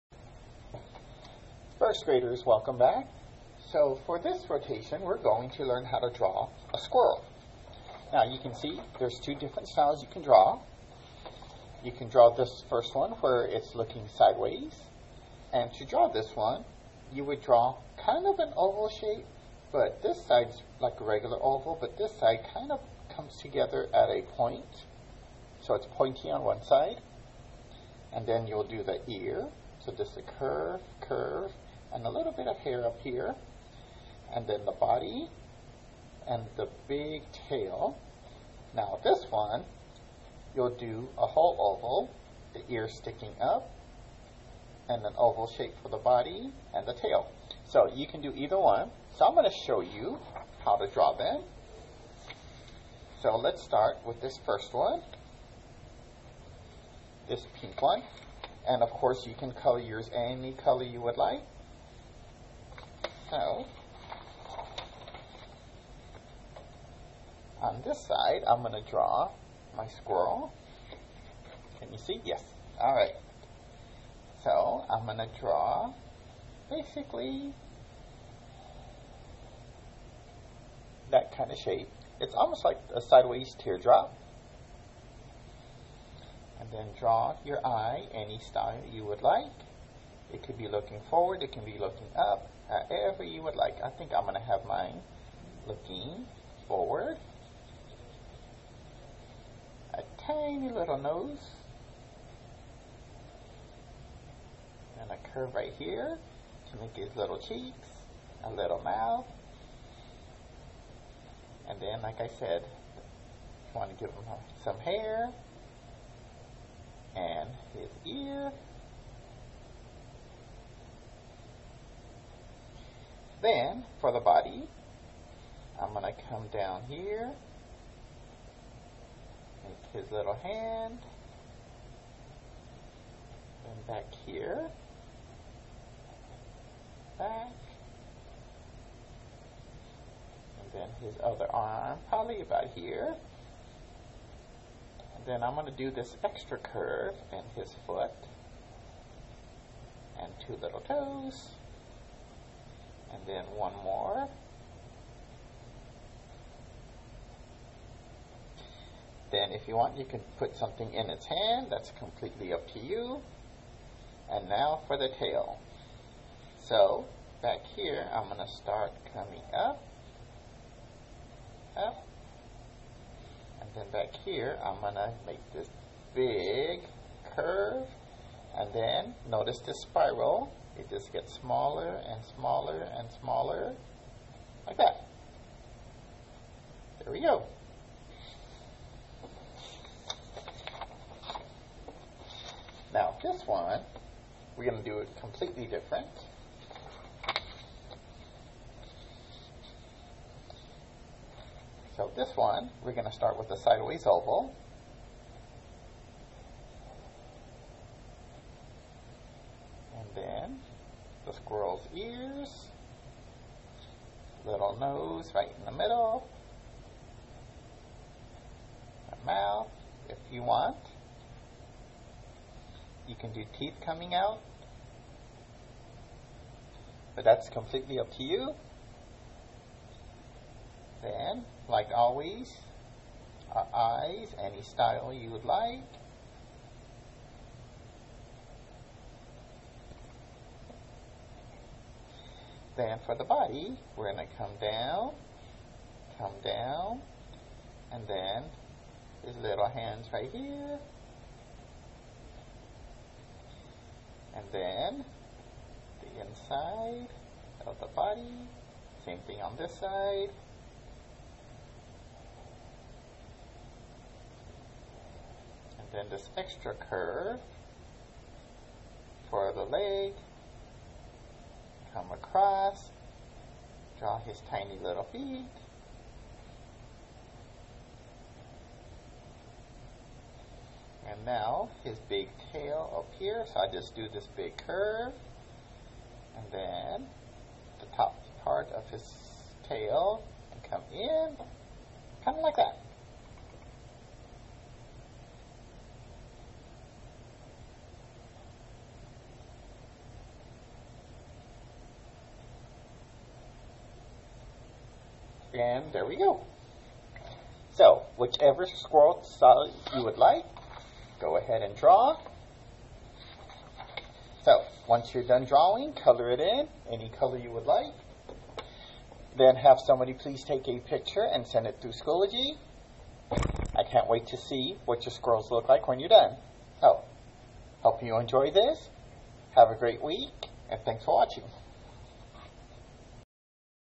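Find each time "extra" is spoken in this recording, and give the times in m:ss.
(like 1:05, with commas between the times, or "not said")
2:26, 4:26.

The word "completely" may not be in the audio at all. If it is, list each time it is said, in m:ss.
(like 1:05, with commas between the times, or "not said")
2:41, 3:15, 3:47.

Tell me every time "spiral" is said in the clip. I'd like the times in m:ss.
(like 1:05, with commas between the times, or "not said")
2:59.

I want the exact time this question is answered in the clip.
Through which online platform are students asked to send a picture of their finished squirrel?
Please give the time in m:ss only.
5:21.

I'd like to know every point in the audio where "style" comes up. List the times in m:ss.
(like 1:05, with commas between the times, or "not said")
0:09, 1:28, 3:54.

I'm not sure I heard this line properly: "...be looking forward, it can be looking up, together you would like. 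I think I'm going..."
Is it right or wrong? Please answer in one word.
wrong.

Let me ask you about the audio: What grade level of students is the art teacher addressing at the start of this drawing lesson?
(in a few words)
First graders.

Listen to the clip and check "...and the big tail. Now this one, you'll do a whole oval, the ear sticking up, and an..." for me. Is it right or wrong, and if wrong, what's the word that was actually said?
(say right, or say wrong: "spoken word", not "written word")
right.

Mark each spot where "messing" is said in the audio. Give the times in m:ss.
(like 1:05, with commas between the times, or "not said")
not said.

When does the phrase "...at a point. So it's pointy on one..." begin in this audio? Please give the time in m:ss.
0:23.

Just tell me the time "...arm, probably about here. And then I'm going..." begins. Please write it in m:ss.
2:21.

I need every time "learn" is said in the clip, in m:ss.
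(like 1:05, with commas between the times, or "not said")
0:05.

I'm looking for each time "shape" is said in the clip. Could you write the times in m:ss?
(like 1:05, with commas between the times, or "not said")
0:18, 0:45, 1:21.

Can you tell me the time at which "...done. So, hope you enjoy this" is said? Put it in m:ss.
5:26.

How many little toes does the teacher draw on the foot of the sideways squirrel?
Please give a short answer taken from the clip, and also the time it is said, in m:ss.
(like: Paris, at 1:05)
2, at 2:30.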